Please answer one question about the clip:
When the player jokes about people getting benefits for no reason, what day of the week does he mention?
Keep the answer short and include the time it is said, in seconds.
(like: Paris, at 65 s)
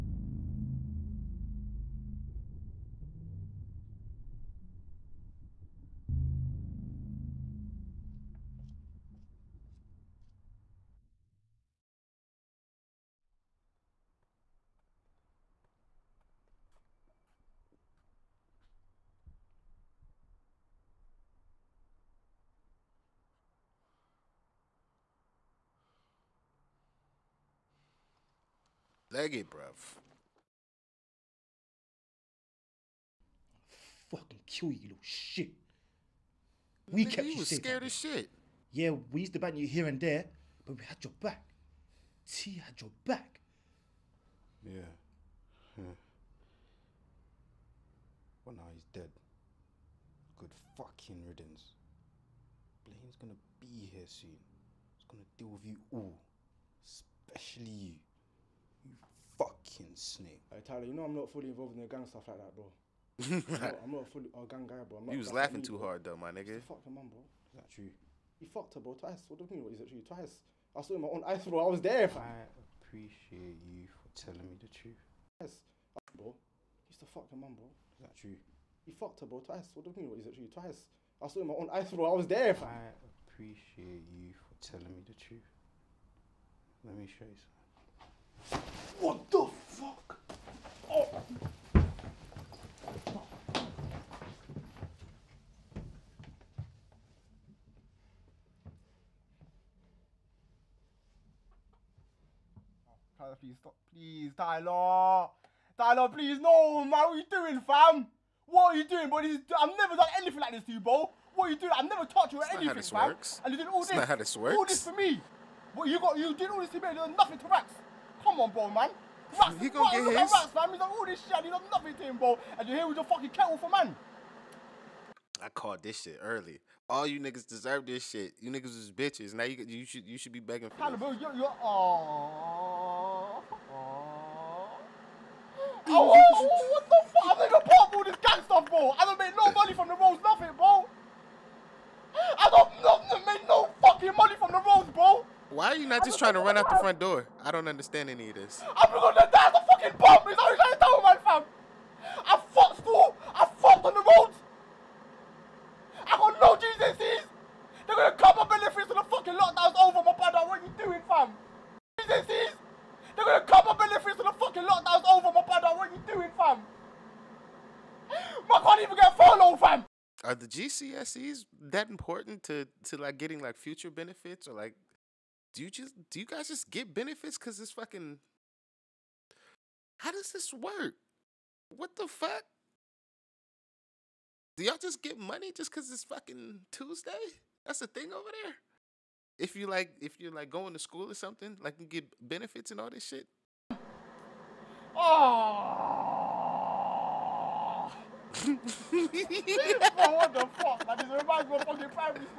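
Tuesday, at 186 s.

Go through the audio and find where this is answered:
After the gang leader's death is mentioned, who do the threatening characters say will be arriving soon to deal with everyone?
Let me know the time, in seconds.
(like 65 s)
52 s.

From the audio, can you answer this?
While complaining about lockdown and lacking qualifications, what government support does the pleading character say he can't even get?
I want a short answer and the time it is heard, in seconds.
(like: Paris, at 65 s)
furlough, at 169 s.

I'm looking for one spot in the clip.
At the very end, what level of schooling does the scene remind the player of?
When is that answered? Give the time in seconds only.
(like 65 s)
201 s.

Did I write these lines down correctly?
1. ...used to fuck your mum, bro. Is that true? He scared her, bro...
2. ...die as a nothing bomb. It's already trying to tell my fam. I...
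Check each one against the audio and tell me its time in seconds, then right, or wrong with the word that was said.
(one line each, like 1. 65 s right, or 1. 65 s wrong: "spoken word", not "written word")
1. 76 s wrong: "fucked", not "scared"
2. 149 s wrong: "fucking", not "nothing".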